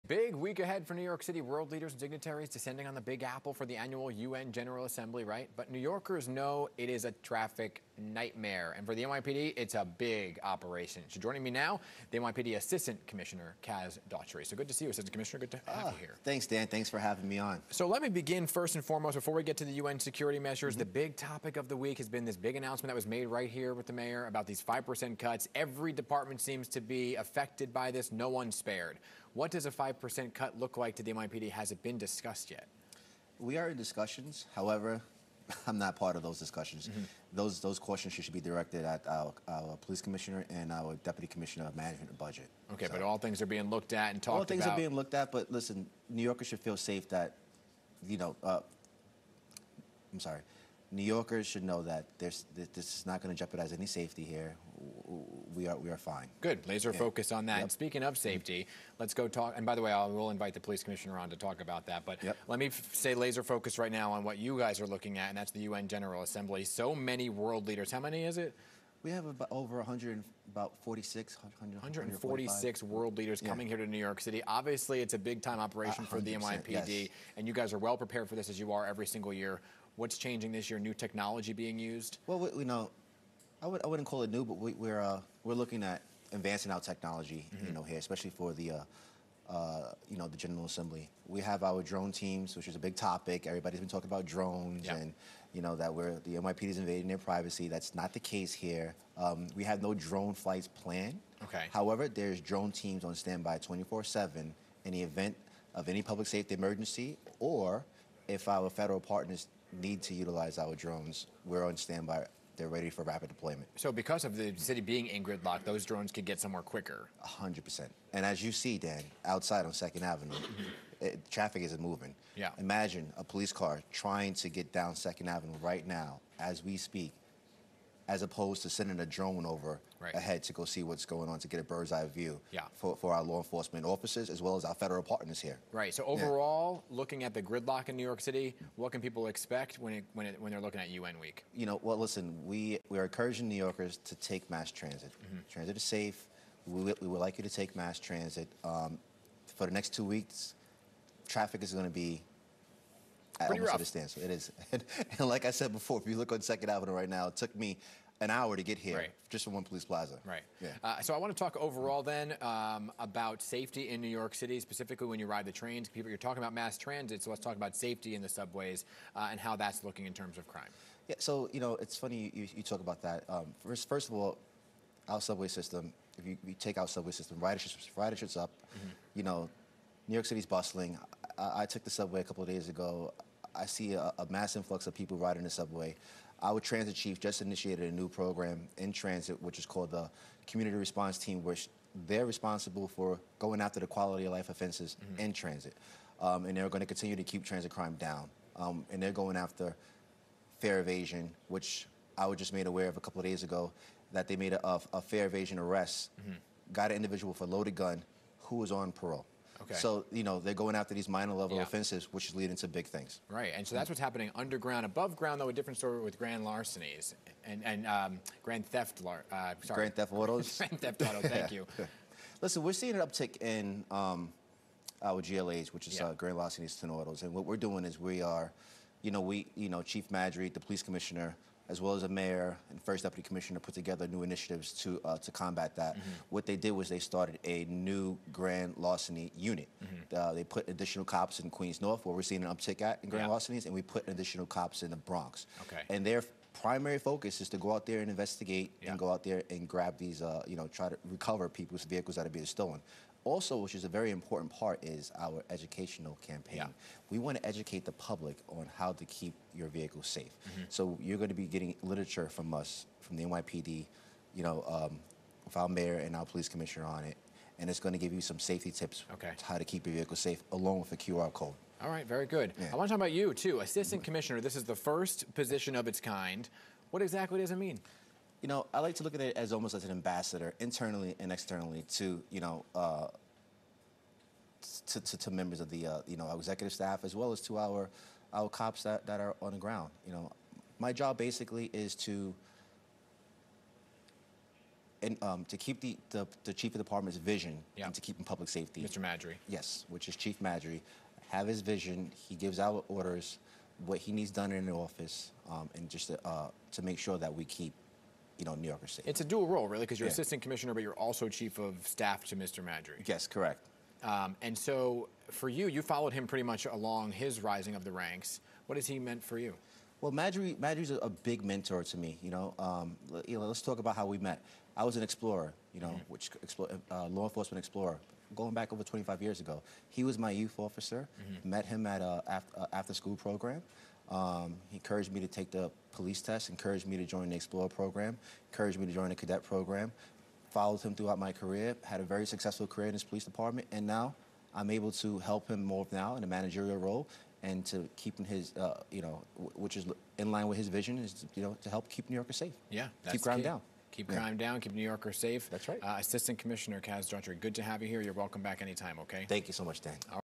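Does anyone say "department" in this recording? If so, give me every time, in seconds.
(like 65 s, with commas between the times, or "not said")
26 s, 296 s, 343 s.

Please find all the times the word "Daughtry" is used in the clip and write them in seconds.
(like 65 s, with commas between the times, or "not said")
14 s, 357 s.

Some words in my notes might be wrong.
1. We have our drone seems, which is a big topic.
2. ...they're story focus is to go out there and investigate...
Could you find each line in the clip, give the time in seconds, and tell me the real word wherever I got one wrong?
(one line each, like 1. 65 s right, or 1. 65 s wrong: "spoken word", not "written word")
1. 91 s wrong: "teams", not "seems"
2. 246 s wrong: "primary", not "story".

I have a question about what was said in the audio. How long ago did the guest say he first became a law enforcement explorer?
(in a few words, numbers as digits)
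over 25 years.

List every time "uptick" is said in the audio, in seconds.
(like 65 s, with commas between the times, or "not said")
223 s, 242 s.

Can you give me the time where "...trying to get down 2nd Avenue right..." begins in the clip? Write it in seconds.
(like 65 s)
123 s.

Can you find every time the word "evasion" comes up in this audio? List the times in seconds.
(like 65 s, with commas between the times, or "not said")
200 s, 205 s.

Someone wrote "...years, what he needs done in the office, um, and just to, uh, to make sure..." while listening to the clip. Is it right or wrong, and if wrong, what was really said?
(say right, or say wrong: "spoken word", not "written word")
wrong: "orders", not "years".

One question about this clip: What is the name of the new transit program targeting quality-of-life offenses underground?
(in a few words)
Community Response Team.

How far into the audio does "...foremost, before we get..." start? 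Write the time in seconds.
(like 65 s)
18 s.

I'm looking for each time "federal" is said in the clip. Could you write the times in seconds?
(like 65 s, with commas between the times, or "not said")
108 s, 134 s.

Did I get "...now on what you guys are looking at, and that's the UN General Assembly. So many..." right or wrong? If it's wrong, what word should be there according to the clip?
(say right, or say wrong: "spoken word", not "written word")
right.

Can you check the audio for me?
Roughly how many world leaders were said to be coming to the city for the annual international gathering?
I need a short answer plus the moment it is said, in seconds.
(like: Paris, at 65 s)
146, at 71 s.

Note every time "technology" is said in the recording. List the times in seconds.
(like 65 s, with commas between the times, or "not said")
80 s, 86 s.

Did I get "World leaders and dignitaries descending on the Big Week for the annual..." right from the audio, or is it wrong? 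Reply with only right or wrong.
wrong.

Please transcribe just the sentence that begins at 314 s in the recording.
Um, and so for you, you followed him pretty much along his rising of the ranks.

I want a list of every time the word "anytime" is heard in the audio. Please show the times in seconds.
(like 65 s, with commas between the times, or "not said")
358 s.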